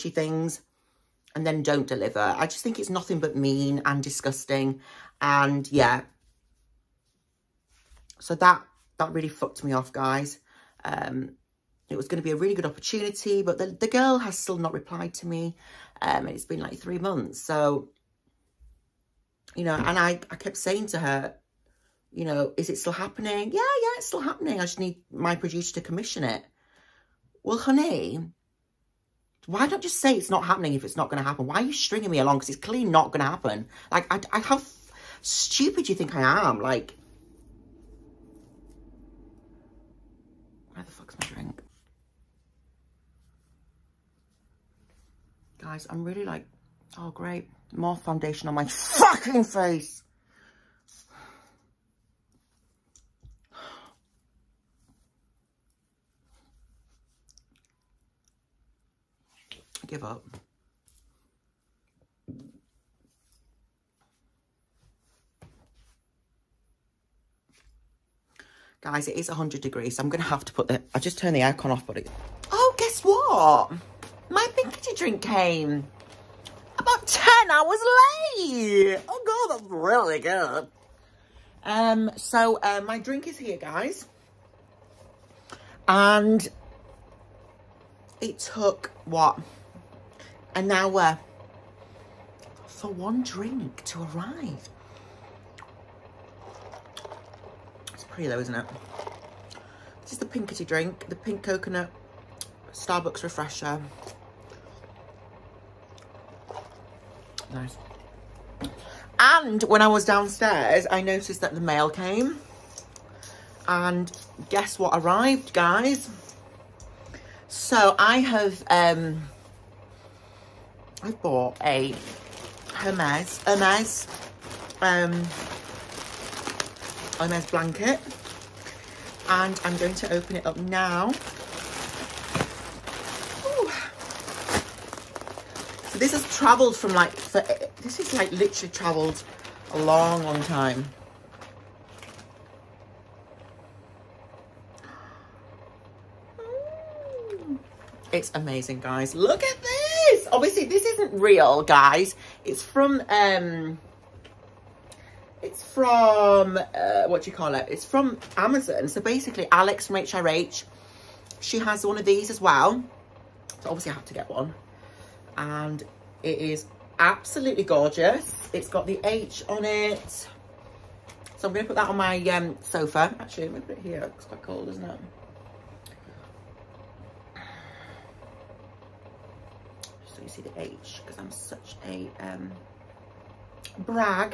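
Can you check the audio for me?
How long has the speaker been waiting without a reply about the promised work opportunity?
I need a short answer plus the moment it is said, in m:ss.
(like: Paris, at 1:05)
3 months, at 0:16.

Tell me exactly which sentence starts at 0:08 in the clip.
So that, that really fucked me off, guys.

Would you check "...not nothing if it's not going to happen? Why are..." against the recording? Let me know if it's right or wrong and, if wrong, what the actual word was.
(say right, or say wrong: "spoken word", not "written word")
wrong: "happening", not "nothing".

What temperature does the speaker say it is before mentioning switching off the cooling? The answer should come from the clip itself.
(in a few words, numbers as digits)
100 degrees.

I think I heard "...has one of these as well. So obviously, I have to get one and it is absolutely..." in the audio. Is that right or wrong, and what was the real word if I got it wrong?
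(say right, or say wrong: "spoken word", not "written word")
right.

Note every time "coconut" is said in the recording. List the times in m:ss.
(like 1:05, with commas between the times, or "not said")
1:41.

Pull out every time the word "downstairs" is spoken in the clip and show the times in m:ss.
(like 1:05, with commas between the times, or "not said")
1:50.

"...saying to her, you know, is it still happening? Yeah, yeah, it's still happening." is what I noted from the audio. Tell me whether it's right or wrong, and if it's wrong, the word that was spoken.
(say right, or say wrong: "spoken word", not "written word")
right.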